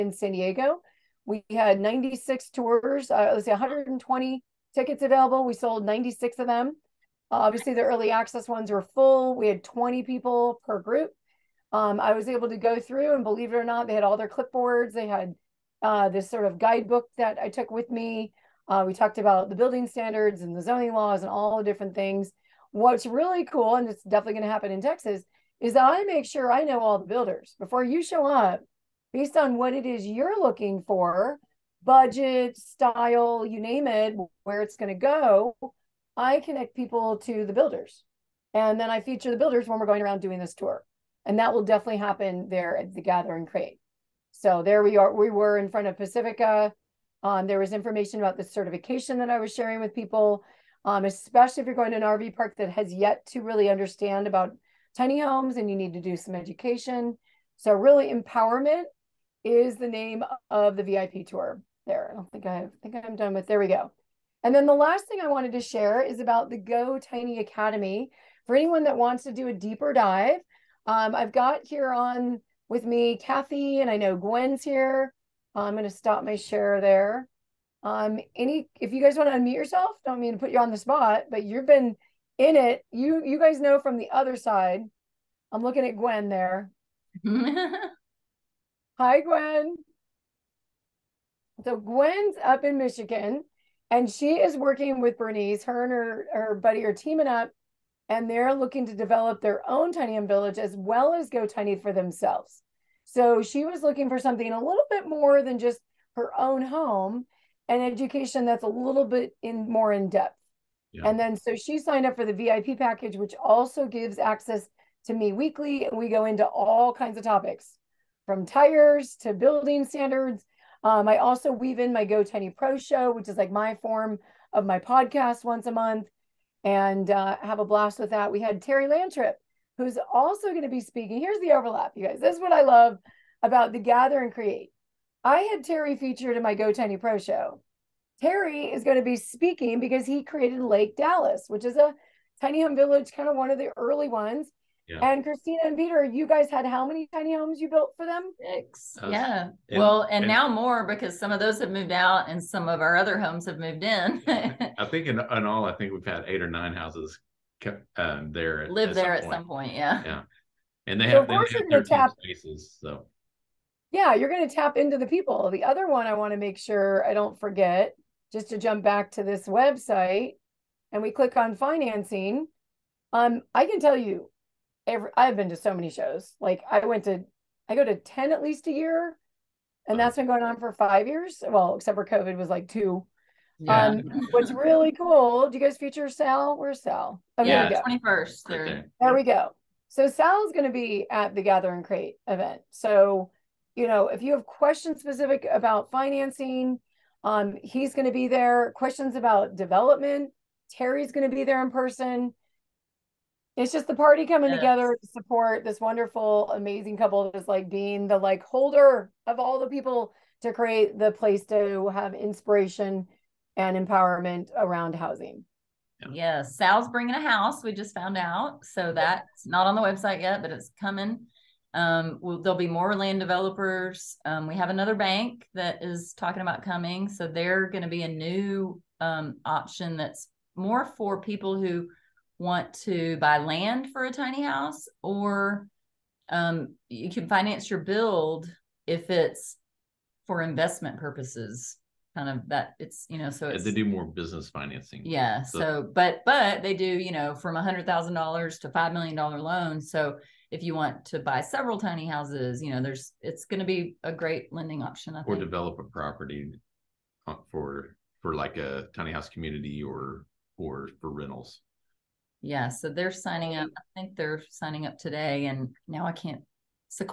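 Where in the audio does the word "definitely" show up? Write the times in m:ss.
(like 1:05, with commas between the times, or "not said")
0:24, 0:41.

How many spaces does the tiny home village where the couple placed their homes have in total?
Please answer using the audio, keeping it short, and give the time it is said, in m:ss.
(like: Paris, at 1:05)
13, at 2:41.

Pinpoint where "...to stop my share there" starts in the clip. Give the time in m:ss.
1:15.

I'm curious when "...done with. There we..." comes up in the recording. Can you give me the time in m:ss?
1:03.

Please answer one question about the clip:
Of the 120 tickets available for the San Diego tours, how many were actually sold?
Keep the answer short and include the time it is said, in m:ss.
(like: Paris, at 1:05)
96, at 0:05.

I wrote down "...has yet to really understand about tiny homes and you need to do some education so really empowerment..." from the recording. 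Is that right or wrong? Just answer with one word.
right.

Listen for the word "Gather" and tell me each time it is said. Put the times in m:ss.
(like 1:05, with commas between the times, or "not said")
0:43, 2:13, 3:11.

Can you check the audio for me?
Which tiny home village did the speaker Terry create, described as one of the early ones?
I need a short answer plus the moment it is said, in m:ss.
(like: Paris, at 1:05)
Lake Dallas, at 2:20.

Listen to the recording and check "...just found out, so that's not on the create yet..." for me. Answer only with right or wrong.
wrong.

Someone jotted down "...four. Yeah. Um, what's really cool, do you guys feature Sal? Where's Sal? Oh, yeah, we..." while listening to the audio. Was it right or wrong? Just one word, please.
wrong.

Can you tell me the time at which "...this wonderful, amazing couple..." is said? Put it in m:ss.
3:25.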